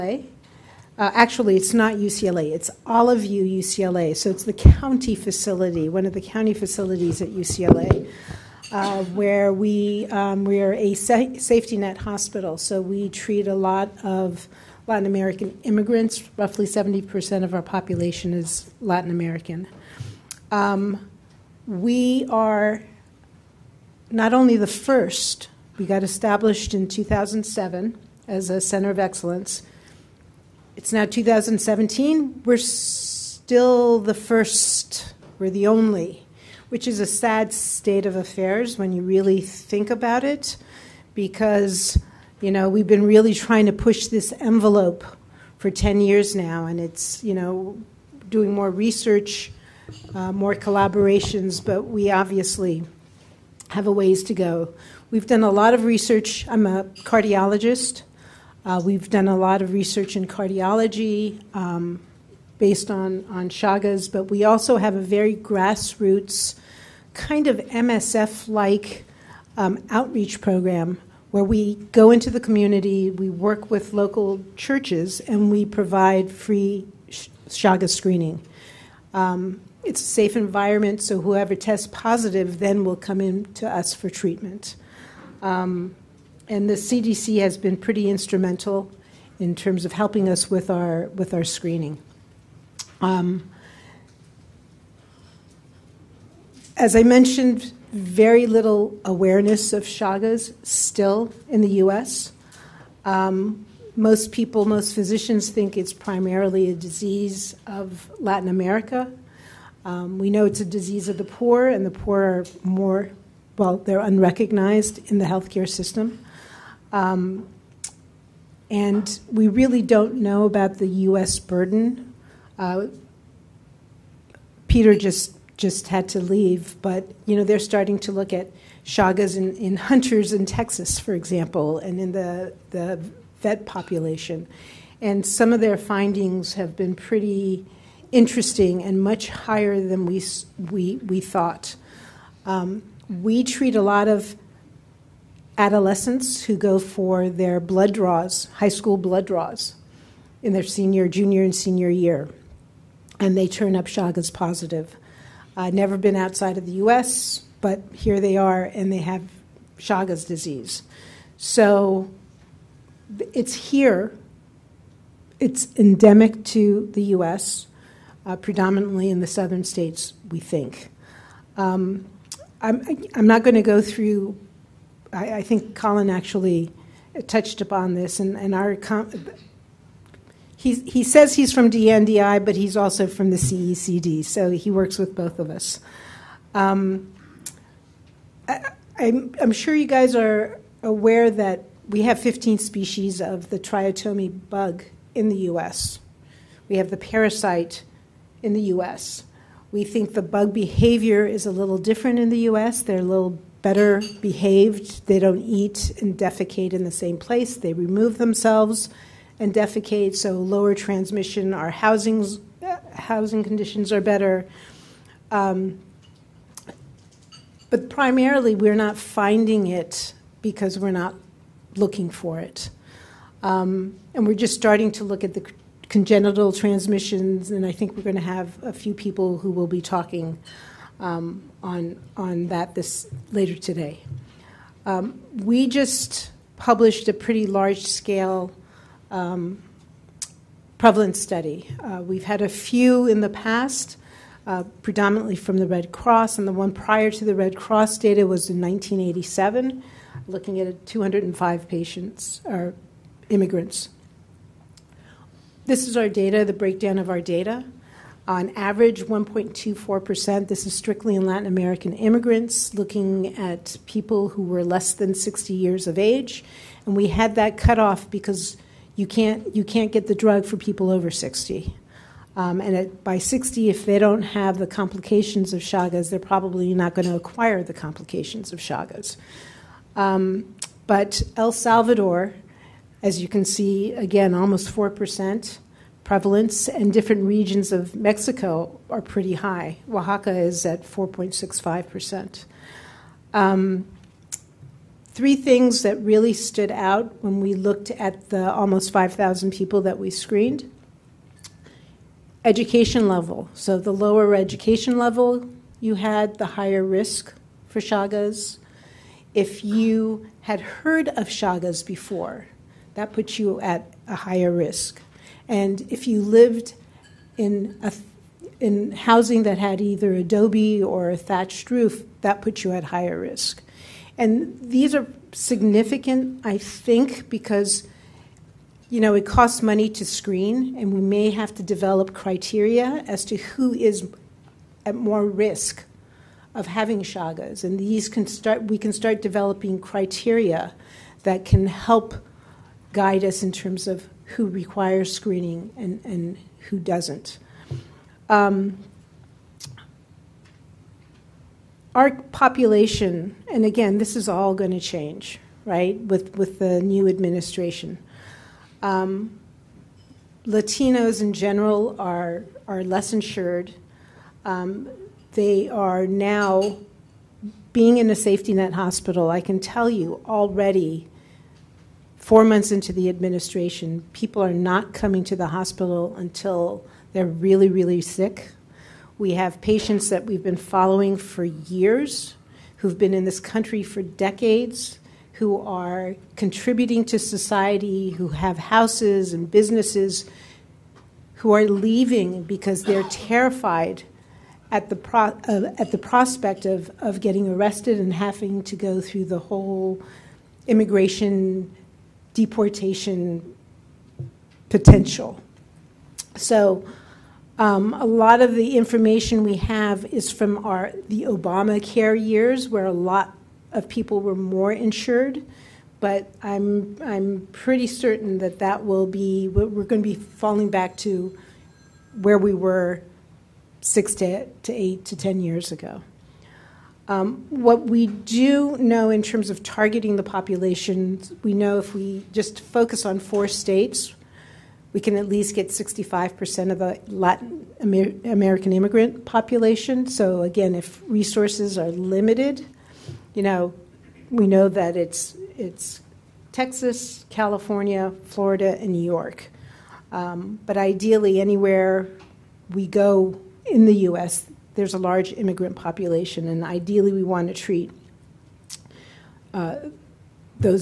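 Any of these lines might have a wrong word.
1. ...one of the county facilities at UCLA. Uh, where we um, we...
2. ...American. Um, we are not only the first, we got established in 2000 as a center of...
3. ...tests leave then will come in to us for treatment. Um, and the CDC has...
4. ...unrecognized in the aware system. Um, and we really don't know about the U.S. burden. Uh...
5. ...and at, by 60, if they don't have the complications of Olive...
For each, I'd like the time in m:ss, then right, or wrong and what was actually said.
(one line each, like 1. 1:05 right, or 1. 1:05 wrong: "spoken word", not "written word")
1. 0:05 right
2. 0:19 wrong: "2007", not "2000"
3. 1:21 wrong: "positive", not "leave"
4. 1:54 wrong: "healthcare", not "aware"
5. 4:32 wrong: "Chagas", not "Olive".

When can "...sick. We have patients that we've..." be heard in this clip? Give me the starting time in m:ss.
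6:18.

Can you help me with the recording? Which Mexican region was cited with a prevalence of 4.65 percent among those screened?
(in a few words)
Oaxaca.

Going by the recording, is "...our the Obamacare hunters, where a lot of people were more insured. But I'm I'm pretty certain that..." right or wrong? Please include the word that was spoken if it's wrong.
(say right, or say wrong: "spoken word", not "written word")
wrong: "years", not "hunters".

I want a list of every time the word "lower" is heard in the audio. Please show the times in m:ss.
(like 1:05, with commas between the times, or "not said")
3:30, 5:03.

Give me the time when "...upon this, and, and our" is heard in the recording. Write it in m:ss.
2:57.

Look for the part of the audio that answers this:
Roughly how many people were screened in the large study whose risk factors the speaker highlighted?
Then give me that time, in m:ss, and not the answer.
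4:58.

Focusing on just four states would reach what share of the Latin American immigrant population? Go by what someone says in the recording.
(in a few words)
65%.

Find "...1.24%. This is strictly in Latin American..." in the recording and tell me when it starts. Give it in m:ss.
4:19.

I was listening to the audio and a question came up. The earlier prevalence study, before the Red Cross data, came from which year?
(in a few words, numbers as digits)
1987.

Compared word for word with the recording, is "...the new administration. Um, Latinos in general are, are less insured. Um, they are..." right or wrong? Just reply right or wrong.
right.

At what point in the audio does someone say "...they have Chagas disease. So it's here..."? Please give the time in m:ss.
2:38.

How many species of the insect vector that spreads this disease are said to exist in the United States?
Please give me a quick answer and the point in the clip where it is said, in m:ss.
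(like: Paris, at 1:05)
15, at 3:12.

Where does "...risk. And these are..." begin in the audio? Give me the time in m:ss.
5:23.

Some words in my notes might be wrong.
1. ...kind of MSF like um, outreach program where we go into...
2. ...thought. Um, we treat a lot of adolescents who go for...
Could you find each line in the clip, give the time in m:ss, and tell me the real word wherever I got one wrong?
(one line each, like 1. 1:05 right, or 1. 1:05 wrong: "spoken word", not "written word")
1. 1:07 right
2. 2:21 right.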